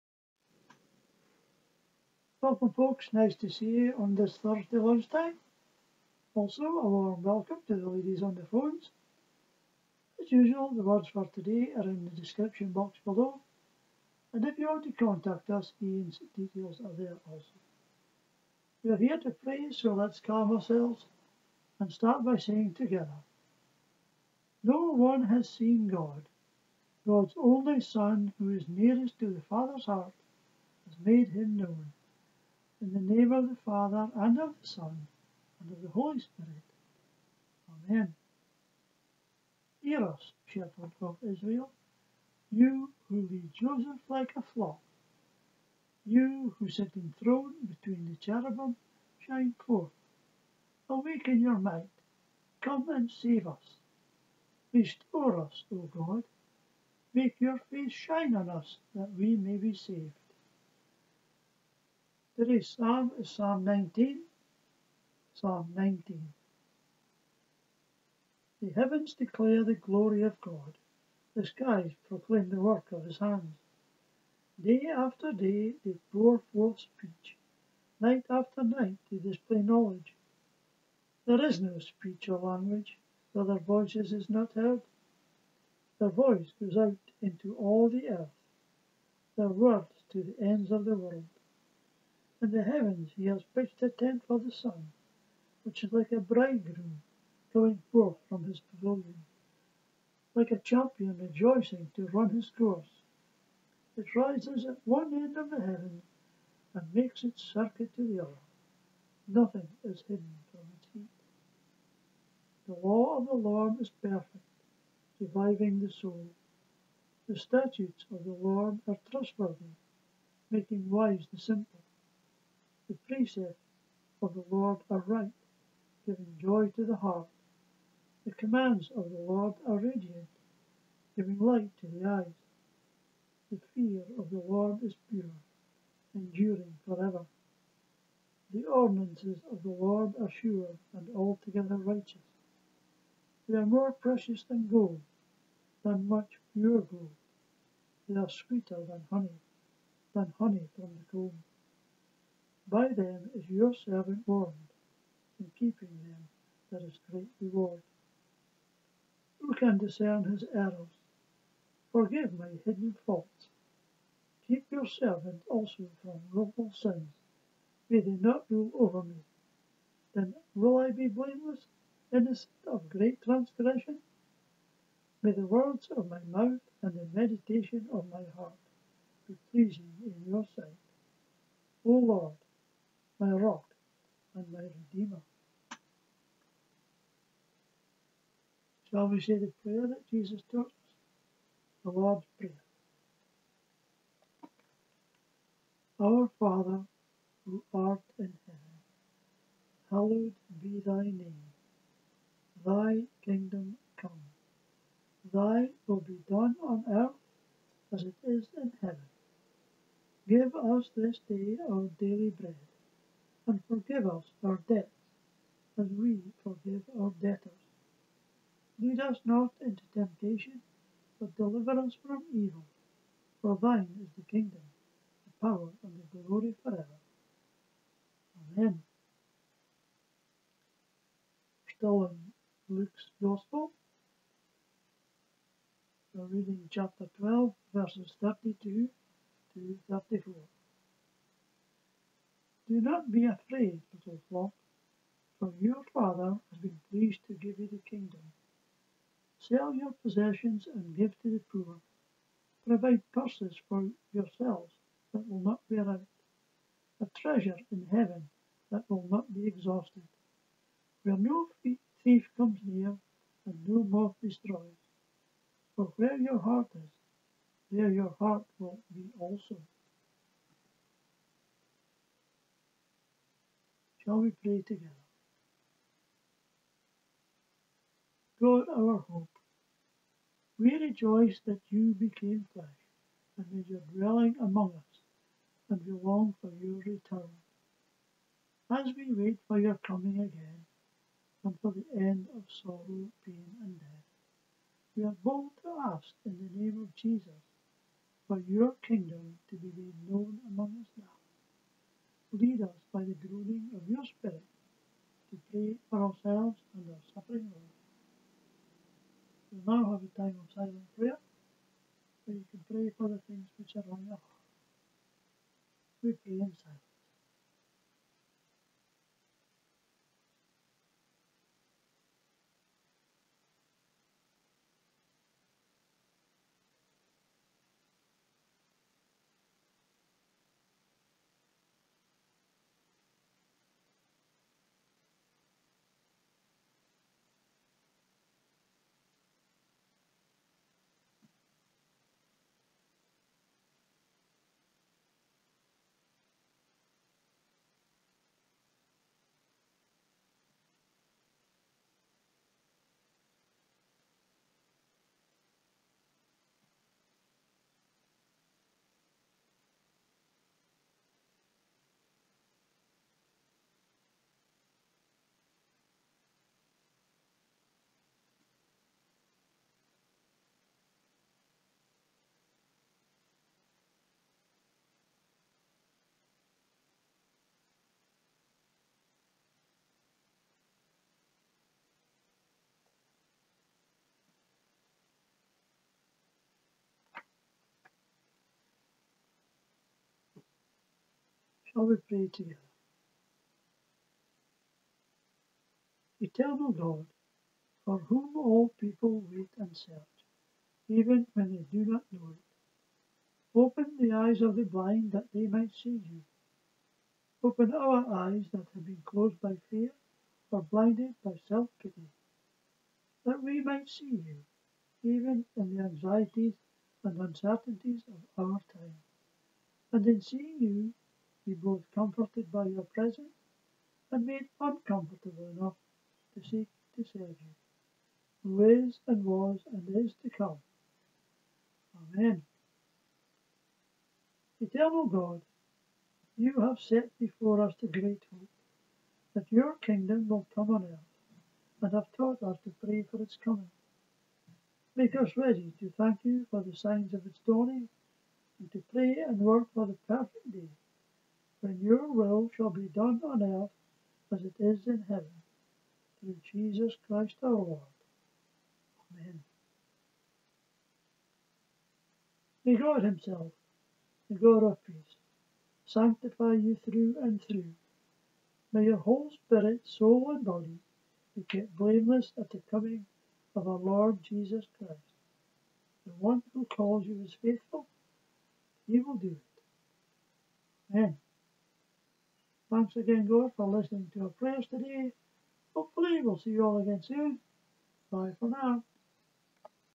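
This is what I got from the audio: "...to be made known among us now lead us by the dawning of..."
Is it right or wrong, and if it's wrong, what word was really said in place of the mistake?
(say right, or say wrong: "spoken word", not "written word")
wrong: "groaning", not "dawning".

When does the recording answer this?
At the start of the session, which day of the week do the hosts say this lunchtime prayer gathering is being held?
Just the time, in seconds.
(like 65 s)
4 s.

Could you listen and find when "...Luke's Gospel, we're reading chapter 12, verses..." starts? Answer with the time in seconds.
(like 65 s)
232 s.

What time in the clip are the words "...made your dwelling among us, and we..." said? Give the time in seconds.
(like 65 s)
283 s.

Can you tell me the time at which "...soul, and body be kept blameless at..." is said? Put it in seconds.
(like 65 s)
469 s.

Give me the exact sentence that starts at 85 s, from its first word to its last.
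Their voice goes out into all the earth, their words to the ends of the world.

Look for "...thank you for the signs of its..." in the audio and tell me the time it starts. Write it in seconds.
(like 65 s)
445 s.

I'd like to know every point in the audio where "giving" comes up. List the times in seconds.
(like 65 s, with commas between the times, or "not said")
126 s, 131 s.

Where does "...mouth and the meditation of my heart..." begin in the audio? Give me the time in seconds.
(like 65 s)
176 s.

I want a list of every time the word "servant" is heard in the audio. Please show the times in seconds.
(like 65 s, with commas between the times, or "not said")
153 s, 164 s.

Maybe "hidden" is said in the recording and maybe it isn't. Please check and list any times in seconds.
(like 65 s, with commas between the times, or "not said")
110 s, 162 s.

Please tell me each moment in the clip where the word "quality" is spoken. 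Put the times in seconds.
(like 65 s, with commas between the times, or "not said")
not said.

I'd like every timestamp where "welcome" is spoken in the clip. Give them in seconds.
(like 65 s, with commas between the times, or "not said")
2 s, 7 s.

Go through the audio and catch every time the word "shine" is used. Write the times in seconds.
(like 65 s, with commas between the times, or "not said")
49 s, 57 s.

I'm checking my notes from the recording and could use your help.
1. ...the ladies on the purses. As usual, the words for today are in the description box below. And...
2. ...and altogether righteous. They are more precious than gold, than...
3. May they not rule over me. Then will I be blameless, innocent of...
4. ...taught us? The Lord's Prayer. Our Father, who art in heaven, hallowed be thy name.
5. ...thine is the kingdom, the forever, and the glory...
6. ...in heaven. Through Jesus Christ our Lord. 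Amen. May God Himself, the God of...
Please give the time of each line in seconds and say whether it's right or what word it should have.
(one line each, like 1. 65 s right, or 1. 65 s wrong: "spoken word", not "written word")
1. 7 s wrong: "phones", not "purses"
2. 140 s right
3. 167 s right
4. 190 s right
5. 223 s wrong: "power", not "forever"
6. 454 s right.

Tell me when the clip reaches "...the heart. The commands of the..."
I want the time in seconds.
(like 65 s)
126 s.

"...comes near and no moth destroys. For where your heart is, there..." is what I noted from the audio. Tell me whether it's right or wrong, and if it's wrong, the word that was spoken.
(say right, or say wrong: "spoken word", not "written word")
right.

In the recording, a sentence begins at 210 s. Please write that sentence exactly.
Give us this day our daily bread and forgive us our debts, as we forgive our debtors.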